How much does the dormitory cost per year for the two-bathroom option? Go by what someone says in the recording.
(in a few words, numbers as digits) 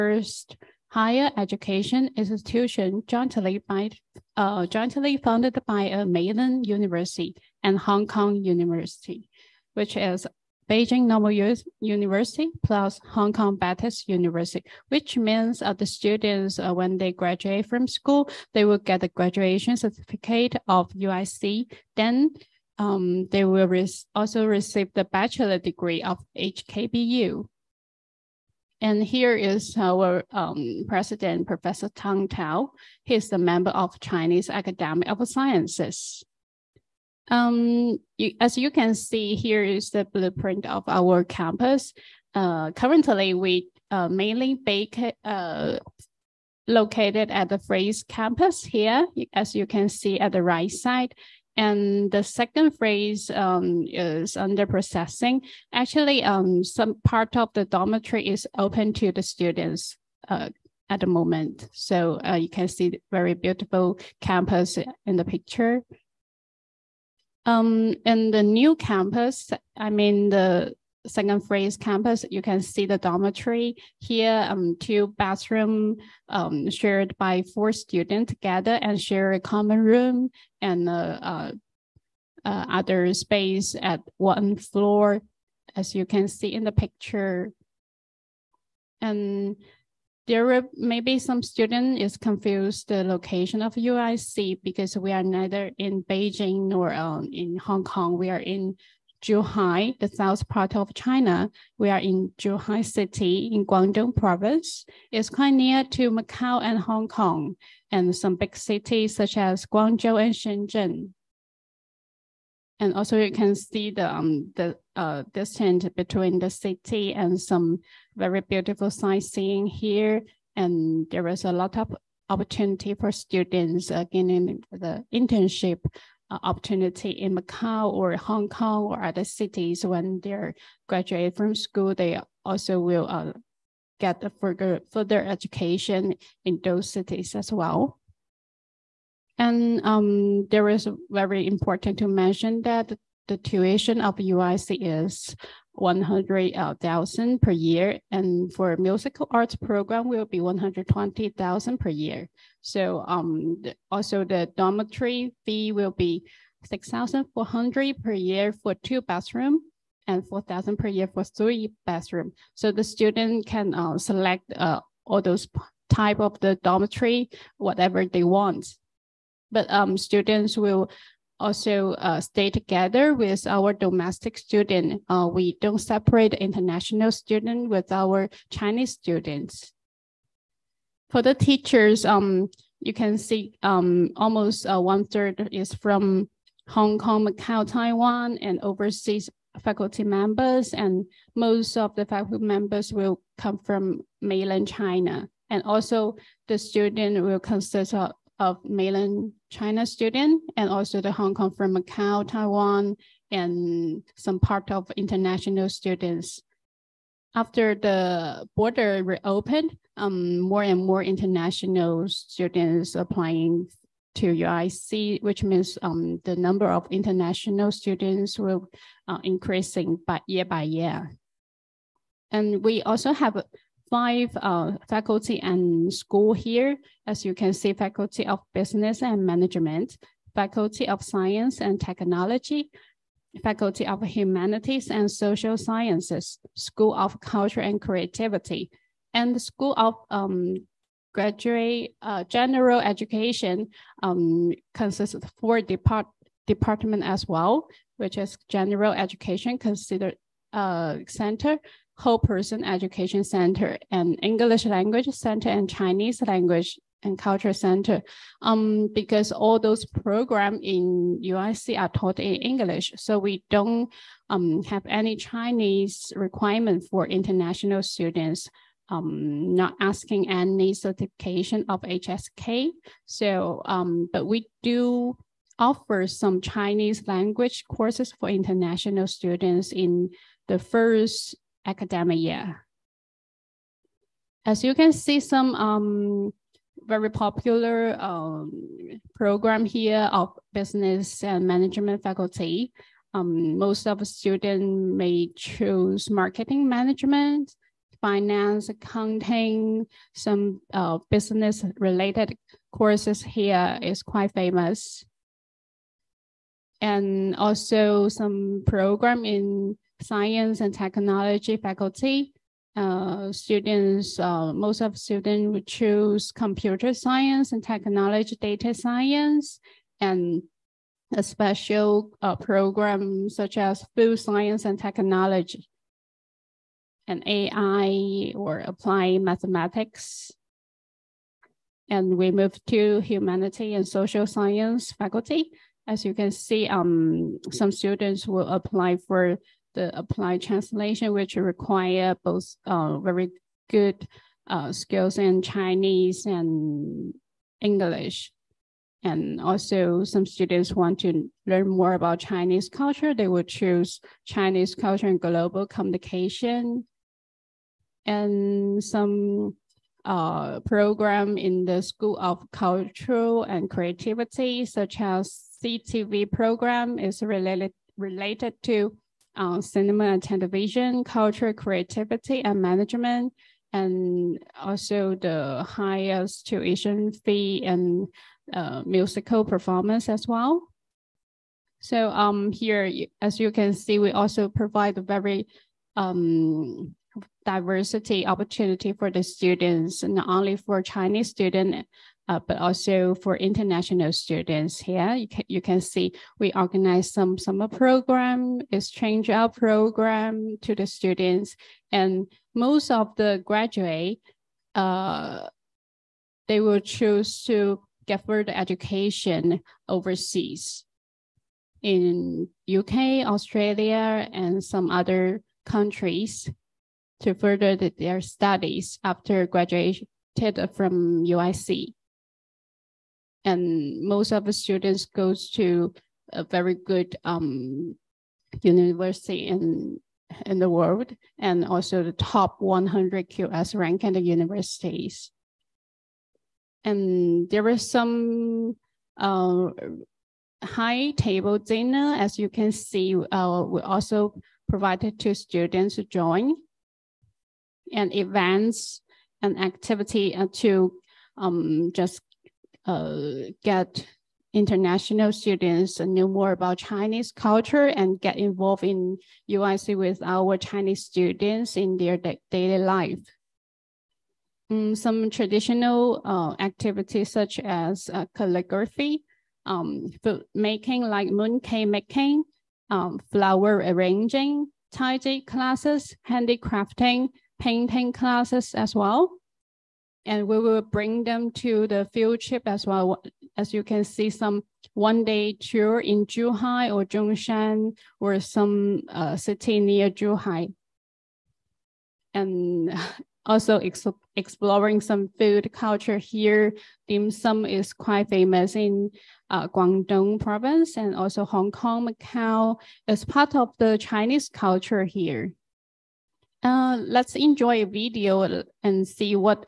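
6,400.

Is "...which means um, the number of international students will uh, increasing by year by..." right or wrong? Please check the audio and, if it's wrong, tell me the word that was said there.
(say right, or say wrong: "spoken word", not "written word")
right.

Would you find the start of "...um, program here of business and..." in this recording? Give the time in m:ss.
4:47.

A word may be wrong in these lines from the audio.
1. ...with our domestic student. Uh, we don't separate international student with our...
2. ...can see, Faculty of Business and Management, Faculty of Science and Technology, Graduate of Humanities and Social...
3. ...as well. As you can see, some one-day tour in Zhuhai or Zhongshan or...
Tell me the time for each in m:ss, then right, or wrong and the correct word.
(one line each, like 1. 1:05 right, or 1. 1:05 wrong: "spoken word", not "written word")
1. 2:53 right
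2. 3:47 wrong: "Faculty", not "Graduate"
3. 8:02 right.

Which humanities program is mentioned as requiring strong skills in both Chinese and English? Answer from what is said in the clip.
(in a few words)
applied translation.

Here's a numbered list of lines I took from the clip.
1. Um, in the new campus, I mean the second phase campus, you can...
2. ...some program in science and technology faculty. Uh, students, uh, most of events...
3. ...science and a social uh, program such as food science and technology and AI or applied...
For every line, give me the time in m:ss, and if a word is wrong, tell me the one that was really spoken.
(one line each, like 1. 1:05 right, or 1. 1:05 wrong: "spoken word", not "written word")
1. 1:07 right
2. 5:08 wrong: "students", not "events"
3. 5:18 wrong: "special", not "social".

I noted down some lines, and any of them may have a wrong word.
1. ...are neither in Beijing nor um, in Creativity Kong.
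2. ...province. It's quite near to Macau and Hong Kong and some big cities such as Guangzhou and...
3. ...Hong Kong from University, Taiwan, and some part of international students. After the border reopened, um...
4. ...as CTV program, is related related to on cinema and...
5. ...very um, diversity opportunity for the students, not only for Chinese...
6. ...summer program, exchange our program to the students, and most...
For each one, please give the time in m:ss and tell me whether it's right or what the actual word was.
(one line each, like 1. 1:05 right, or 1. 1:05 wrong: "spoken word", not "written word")
1. 1:35 wrong: "Hong", not "Creativity"
2. 1:44 right
3. 3:21 wrong: "Macau", not "University"
4. 6:04 right
5. 6:25 right
6. 6:37 right.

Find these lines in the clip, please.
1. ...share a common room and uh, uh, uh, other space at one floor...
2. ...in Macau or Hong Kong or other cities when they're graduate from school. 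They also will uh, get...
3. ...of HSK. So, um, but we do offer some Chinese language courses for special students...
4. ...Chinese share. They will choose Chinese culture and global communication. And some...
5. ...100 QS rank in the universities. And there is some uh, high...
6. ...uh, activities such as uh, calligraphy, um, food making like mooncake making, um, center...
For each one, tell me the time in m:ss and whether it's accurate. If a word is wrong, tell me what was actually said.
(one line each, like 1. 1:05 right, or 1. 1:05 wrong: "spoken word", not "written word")
1. 1:18 right
2. 2:07 right
3. 4:31 wrong: "international", not "special"
4. 5:52 wrong: "culture", not "share"
5. 7:12 right
6. 7:46 wrong: "flower", not "center".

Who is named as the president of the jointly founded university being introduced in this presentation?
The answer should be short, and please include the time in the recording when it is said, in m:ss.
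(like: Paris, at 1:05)
Professor Tang Tao, at 0:31.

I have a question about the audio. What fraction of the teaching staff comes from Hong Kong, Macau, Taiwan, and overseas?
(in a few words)
one third.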